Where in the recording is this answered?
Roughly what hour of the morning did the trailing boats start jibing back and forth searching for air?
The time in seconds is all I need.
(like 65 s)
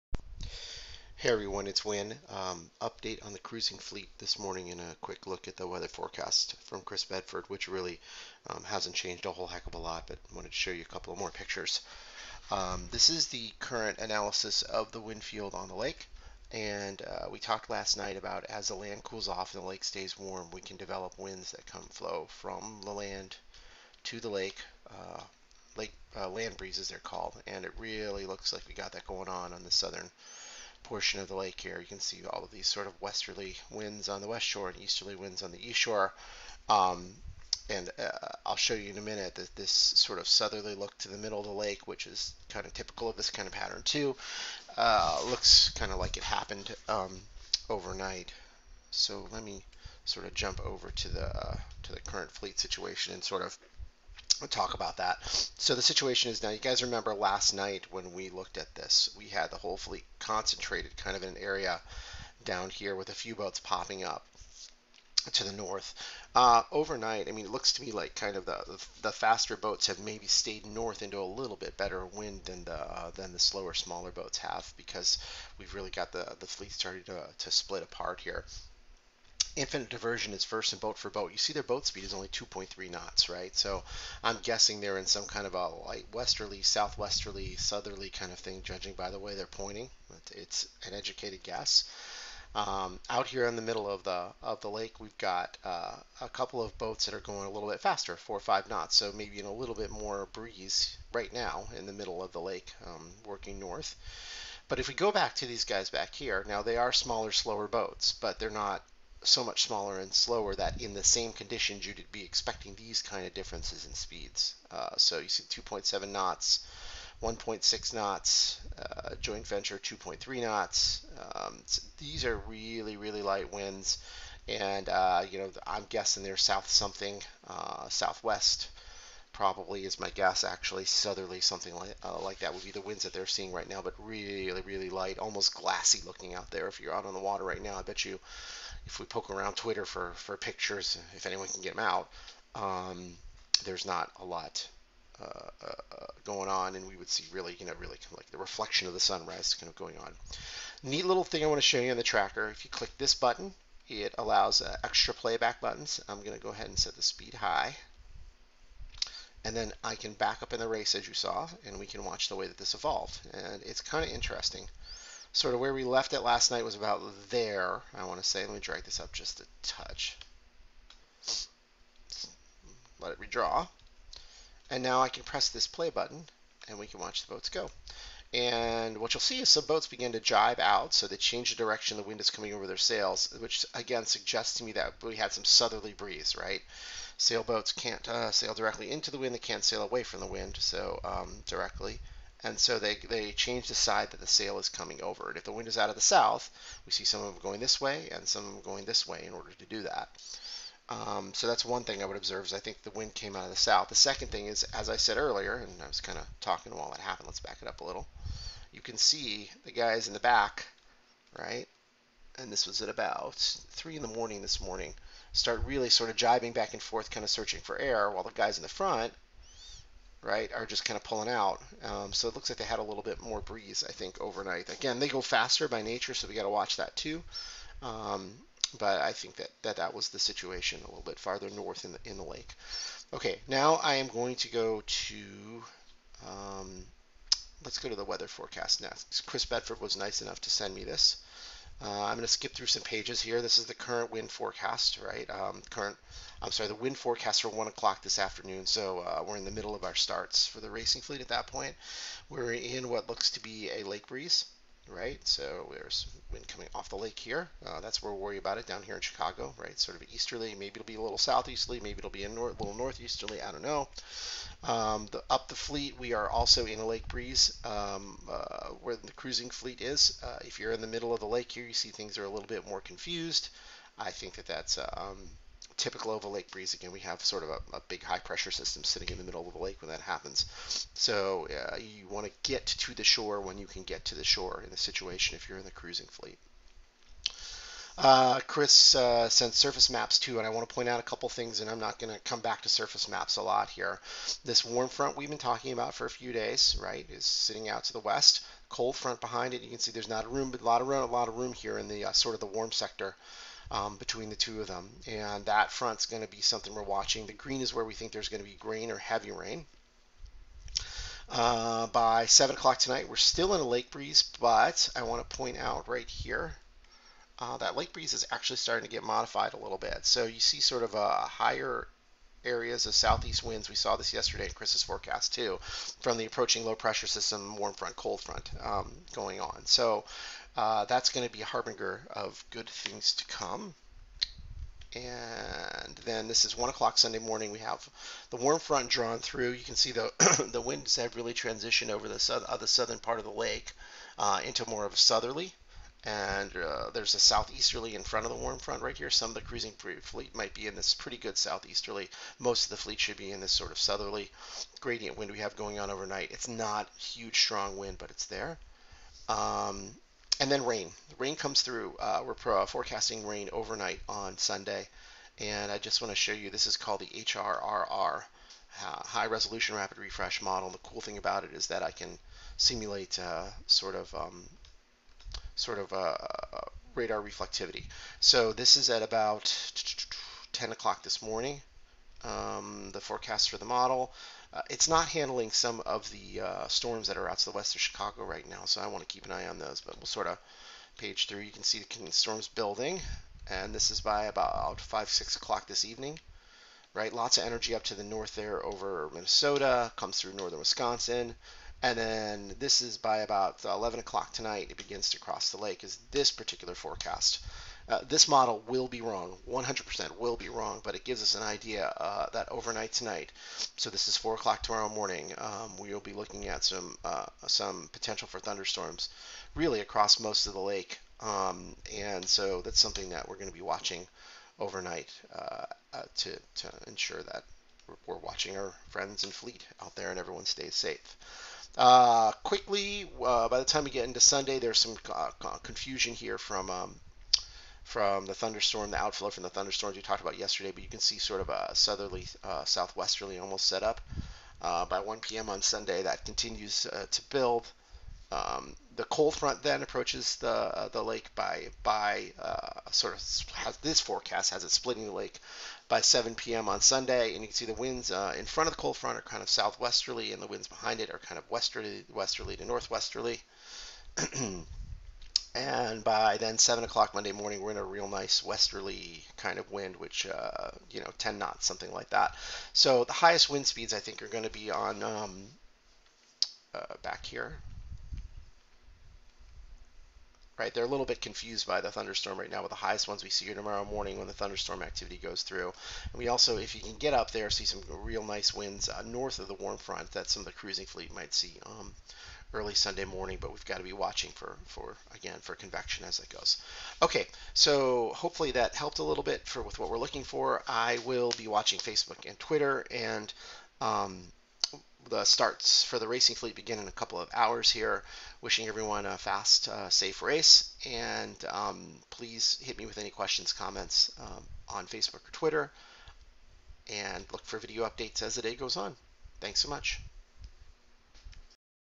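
213 s.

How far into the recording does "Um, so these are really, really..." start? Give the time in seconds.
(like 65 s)
121 s.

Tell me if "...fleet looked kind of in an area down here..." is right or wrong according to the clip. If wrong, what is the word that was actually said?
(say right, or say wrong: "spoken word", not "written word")
wrong: "concentrated", not "looked".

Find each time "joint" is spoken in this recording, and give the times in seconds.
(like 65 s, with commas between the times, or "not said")
119 s.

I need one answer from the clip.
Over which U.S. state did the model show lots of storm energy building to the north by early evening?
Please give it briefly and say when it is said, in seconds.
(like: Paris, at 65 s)
Minnesota, at 399 s.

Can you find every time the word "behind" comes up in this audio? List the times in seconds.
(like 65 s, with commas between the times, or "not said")
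299 s, 460 s.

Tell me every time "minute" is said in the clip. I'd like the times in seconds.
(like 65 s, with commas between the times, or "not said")
39 s.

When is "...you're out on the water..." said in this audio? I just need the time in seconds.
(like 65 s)
136 s.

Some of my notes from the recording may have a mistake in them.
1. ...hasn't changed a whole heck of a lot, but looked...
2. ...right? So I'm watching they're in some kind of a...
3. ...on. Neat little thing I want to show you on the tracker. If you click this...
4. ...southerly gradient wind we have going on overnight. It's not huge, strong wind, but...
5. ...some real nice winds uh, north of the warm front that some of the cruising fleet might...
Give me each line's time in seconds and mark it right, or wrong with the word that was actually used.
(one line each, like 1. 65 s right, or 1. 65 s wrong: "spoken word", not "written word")
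1. 8 s wrong: "wanted", not "looked"
2. 83 s wrong: "guessing", not "watching"
3. 149 s right
4. 353 s right
5. 487 s right.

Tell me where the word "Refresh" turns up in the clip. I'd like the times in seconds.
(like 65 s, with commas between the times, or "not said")
369 s.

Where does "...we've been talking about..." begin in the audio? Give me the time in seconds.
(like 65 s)
295 s.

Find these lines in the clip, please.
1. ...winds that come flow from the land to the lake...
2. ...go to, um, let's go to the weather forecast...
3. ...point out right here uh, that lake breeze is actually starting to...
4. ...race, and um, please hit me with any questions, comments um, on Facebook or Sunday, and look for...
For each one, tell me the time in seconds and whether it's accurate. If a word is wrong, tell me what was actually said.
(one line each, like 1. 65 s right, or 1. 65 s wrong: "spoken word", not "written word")
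1. 21 s right
2. 234 s right
3. 315 s right
4. 510 s wrong: "Twitter", not "Sunday".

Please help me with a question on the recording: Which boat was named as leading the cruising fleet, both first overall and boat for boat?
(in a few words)
Infinite Diversion.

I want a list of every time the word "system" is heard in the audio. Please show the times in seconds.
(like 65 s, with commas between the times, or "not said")
278 s, 327 s.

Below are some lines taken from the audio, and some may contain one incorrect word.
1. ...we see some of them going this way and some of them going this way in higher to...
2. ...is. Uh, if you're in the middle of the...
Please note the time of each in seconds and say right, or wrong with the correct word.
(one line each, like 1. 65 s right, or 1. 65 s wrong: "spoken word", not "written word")
1. 196 s wrong: "order", not "higher"
2. 269 s right.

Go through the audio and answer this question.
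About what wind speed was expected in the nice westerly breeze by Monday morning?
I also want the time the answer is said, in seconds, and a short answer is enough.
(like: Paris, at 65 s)
10 knots, at 471 s.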